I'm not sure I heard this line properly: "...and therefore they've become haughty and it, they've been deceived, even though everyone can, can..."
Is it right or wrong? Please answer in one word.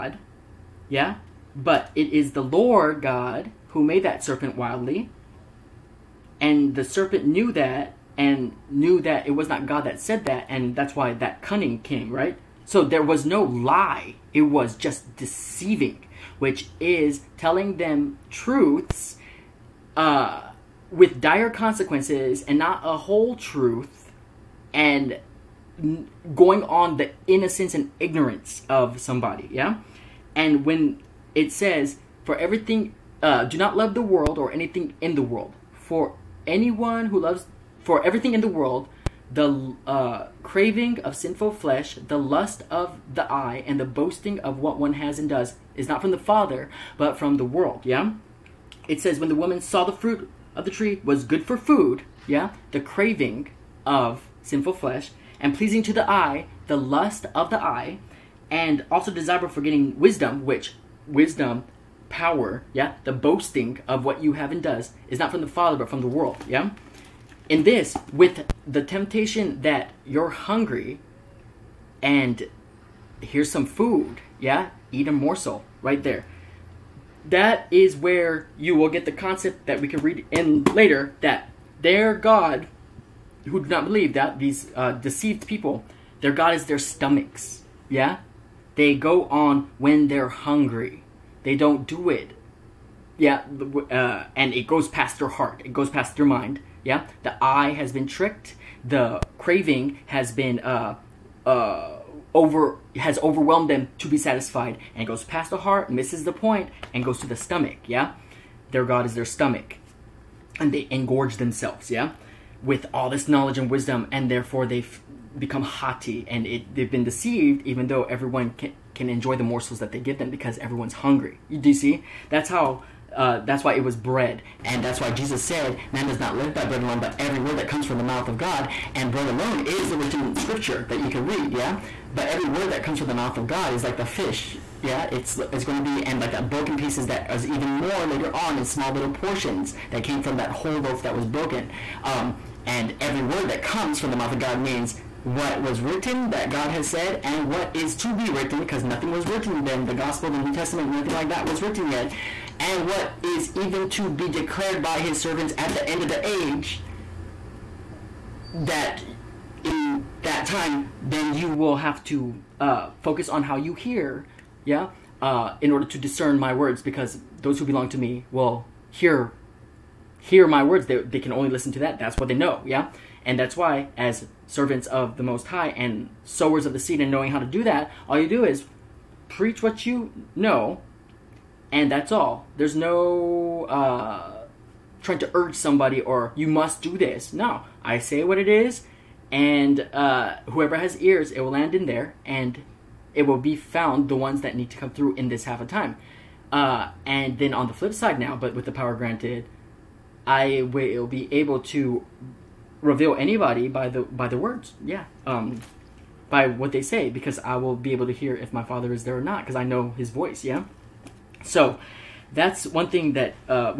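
right.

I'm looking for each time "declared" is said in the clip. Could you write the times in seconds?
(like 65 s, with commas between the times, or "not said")
154 s.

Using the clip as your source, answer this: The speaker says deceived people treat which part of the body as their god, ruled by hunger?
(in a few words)
Their stomachs.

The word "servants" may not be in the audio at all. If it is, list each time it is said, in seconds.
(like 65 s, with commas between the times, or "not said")
155 s, 174 s.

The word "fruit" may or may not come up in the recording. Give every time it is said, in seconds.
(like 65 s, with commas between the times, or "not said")
49 s.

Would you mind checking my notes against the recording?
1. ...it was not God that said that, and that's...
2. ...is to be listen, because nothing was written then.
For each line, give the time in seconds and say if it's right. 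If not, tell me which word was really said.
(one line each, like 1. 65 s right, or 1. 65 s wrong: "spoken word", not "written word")
1. 9 s right
2. 147 s wrong: "written", not "listen".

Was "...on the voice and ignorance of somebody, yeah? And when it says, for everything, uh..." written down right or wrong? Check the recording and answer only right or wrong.
wrong.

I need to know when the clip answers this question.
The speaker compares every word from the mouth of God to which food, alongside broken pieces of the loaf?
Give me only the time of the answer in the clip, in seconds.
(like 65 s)
133 s.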